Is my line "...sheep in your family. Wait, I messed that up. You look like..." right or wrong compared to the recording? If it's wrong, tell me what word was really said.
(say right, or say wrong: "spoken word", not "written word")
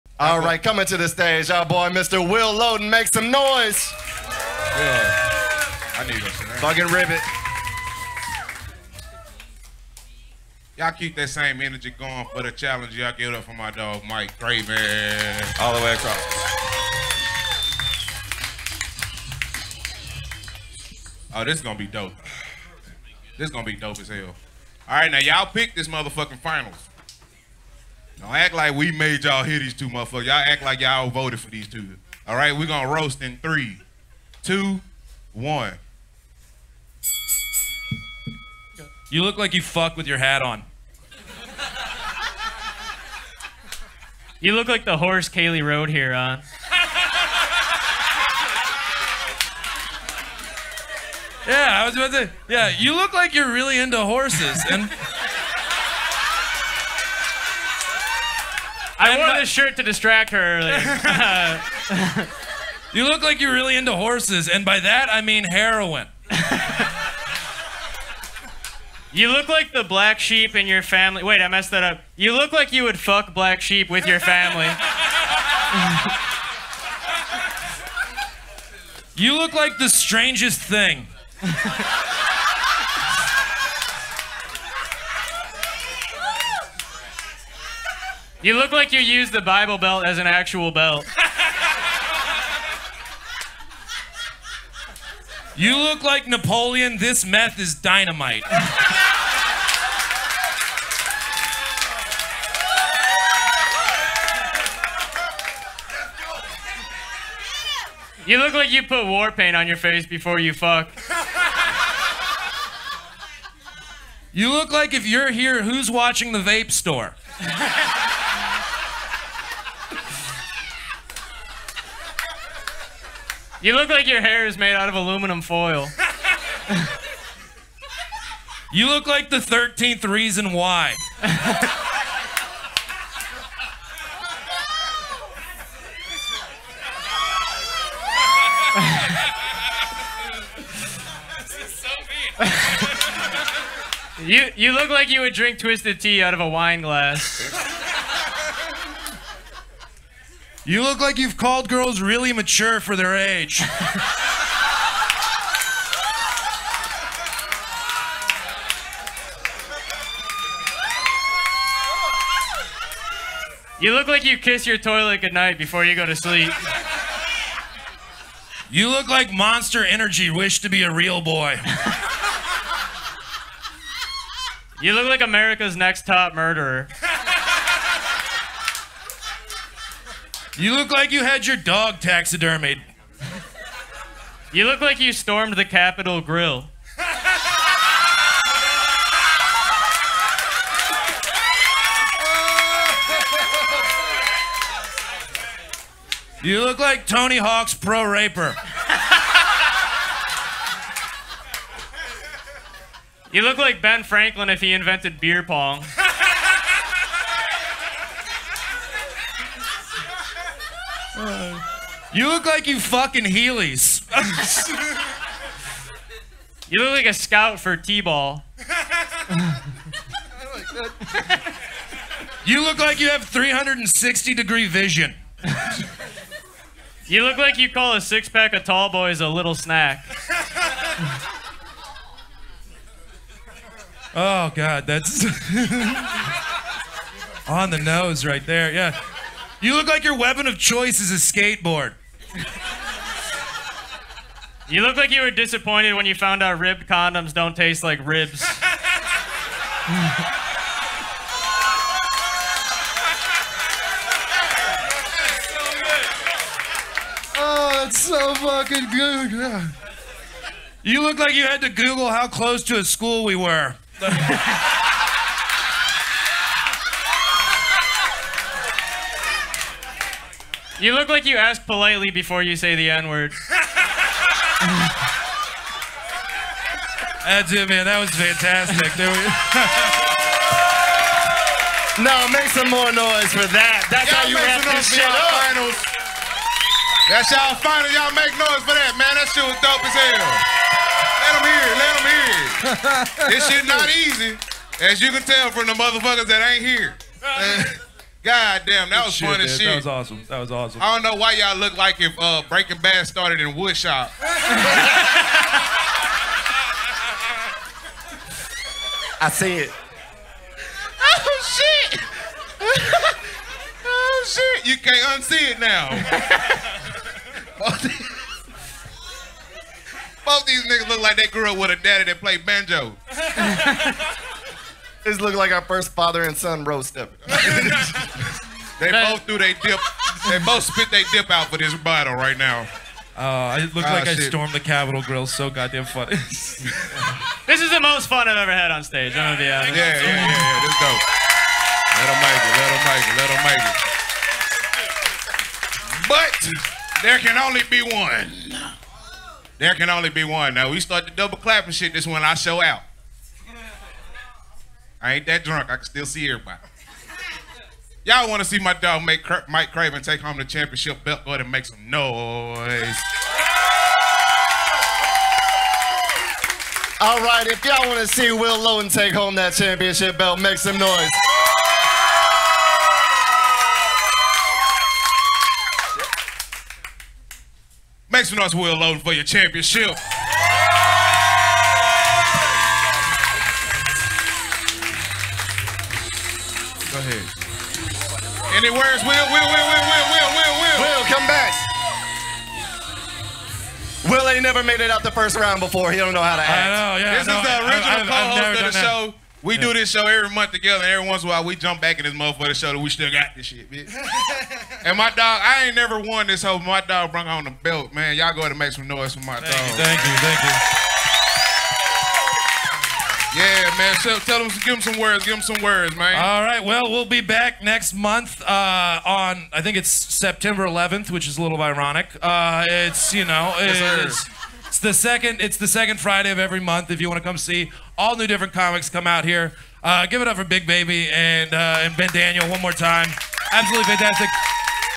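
right.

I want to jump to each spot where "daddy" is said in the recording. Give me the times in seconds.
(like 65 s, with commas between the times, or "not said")
321 s.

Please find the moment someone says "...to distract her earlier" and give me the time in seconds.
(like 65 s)
59 s.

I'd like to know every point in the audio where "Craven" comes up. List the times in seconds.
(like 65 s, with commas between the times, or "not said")
14 s, 359 s.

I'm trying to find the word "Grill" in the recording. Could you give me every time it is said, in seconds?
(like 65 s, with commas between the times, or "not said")
186 s, 335 s.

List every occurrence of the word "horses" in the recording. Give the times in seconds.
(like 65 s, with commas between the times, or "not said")
44 s, 53 s, 63 s.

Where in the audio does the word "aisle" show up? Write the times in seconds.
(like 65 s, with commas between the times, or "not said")
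not said.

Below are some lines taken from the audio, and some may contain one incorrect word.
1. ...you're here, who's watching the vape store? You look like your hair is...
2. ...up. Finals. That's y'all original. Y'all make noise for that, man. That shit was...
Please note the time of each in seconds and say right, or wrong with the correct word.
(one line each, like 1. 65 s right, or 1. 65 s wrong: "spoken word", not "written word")
1. 115 s right
2. 285 s wrong: "final", not "original".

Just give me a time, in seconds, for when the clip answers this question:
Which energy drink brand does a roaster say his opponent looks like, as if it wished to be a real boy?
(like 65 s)
169 s.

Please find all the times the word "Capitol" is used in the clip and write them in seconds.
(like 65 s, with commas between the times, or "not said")
185 s, 334 s.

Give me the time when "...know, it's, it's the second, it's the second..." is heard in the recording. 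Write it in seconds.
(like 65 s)
423 s.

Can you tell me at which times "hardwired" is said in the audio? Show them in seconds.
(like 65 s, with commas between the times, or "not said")
not said.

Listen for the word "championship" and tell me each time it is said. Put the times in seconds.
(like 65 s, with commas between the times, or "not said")
360 s, 369 s, 379 s.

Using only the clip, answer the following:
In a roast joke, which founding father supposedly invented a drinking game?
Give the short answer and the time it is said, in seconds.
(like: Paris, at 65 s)
Ben Franklin, at 203 s.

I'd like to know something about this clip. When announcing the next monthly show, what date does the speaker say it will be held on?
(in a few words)
September 11th.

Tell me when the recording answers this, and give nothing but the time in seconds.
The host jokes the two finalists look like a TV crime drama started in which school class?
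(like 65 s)
303 s.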